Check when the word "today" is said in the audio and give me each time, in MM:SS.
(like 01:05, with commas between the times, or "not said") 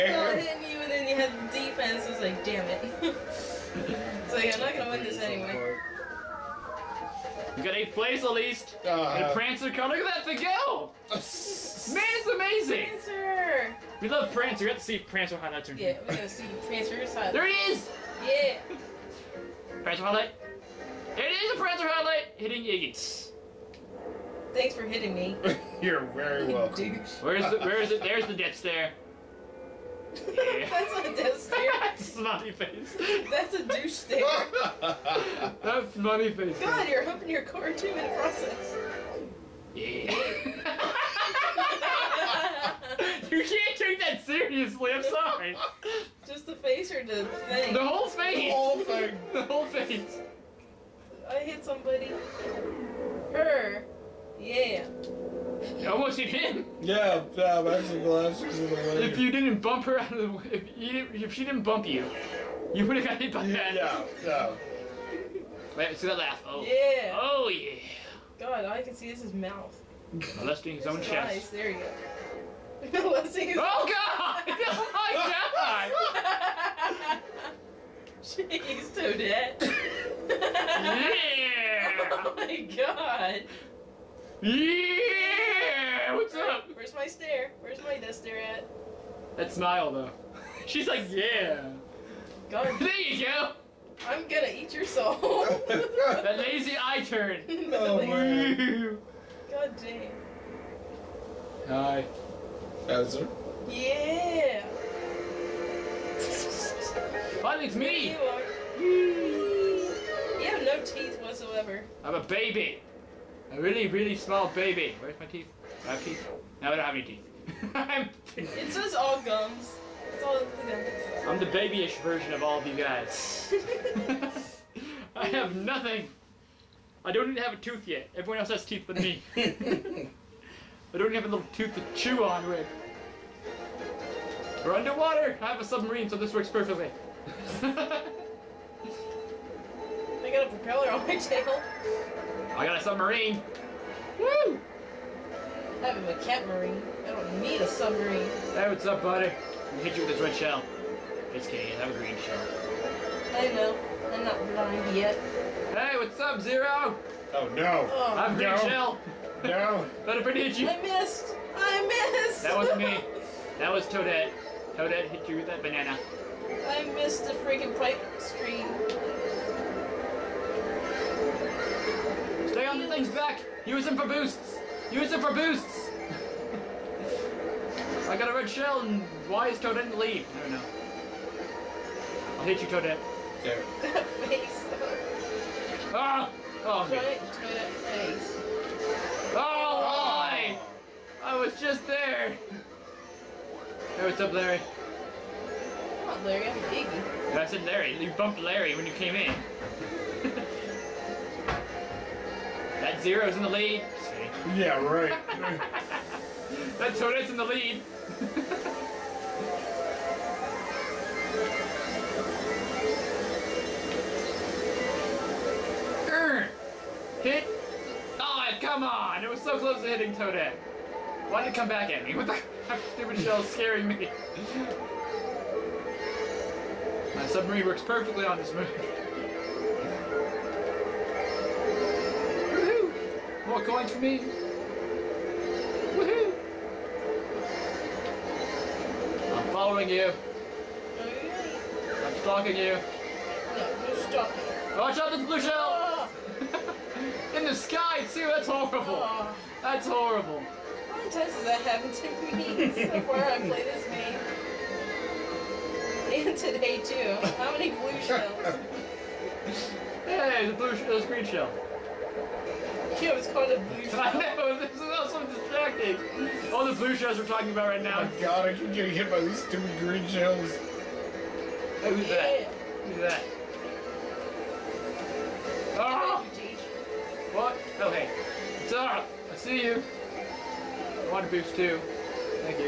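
04:16.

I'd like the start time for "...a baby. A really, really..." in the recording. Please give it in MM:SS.
01:52.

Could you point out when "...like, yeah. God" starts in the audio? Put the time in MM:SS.
01:30.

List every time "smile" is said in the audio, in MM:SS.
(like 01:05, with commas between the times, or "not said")
01:29.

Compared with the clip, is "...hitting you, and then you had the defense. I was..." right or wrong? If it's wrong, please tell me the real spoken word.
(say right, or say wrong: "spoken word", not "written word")
right.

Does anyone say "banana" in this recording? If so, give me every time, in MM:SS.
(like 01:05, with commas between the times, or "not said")
02:45.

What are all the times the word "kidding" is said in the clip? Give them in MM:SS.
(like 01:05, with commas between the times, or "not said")
02:31.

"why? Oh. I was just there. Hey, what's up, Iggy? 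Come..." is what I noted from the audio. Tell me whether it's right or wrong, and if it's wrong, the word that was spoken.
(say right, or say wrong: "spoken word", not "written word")
wrong: "Larry", not "Iggy".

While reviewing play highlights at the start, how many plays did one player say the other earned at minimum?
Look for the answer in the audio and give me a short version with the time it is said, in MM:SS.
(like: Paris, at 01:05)
8, at 00:07.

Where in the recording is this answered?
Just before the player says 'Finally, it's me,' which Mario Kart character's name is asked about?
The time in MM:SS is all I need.
01:42.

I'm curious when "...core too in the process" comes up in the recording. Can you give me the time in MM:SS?
00:37.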